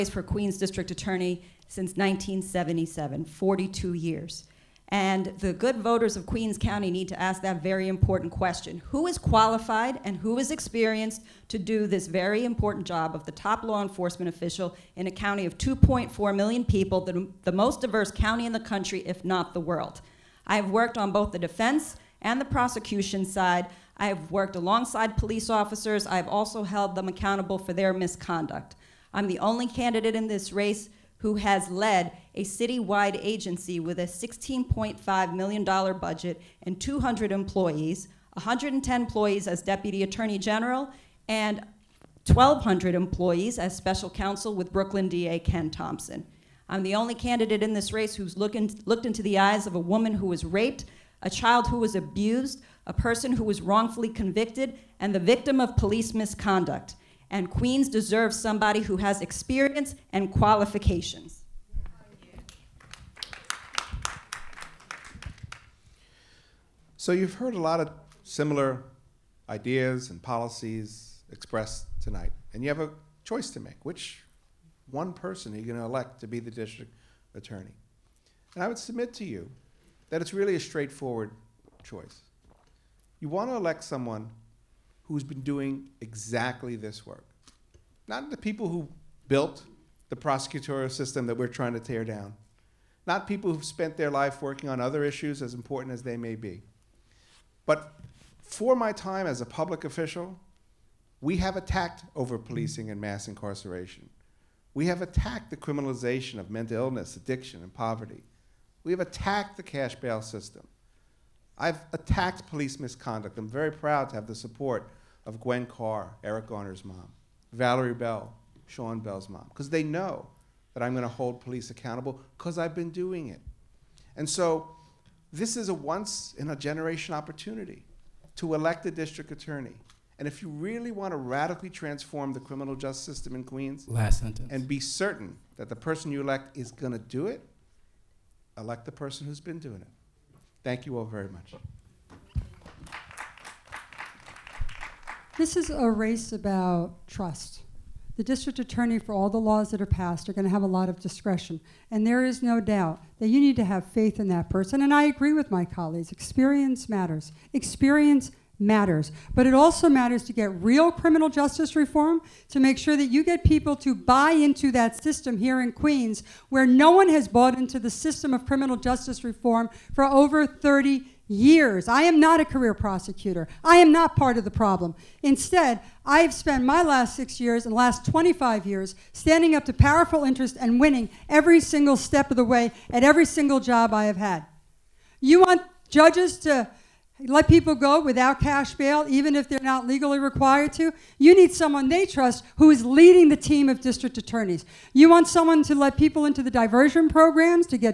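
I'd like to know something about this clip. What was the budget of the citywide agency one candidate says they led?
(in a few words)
$16.5 million.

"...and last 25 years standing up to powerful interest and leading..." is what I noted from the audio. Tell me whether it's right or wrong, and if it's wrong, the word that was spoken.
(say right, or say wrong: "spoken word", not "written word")
wrong: "winning", not "leading".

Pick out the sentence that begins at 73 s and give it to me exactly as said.
Which one person are you going to elect to be the district attorney?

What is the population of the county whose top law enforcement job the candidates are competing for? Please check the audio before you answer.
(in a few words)
2.4 million.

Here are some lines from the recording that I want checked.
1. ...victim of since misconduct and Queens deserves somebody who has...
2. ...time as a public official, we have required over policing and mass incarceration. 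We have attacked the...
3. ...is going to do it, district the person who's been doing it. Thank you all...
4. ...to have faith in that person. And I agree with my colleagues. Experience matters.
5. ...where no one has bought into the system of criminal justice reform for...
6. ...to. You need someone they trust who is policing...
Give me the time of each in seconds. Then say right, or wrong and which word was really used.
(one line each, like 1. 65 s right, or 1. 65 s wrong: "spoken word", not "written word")
1. 55 s wrong: "police", not "since"
2. 98 s wrong: "attacked", not "required"
3. 136 s wrong: "elect", not "district"
4. 153 s right
5. 166 s right
6. 190 s wrong: "leading", not "policing".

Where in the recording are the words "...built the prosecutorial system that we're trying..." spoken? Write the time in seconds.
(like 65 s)
89 s.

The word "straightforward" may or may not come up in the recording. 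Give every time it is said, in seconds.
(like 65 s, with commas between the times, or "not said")
80 s.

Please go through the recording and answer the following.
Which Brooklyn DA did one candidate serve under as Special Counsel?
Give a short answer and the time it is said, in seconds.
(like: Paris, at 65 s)
Ken Thompson, at 45 s.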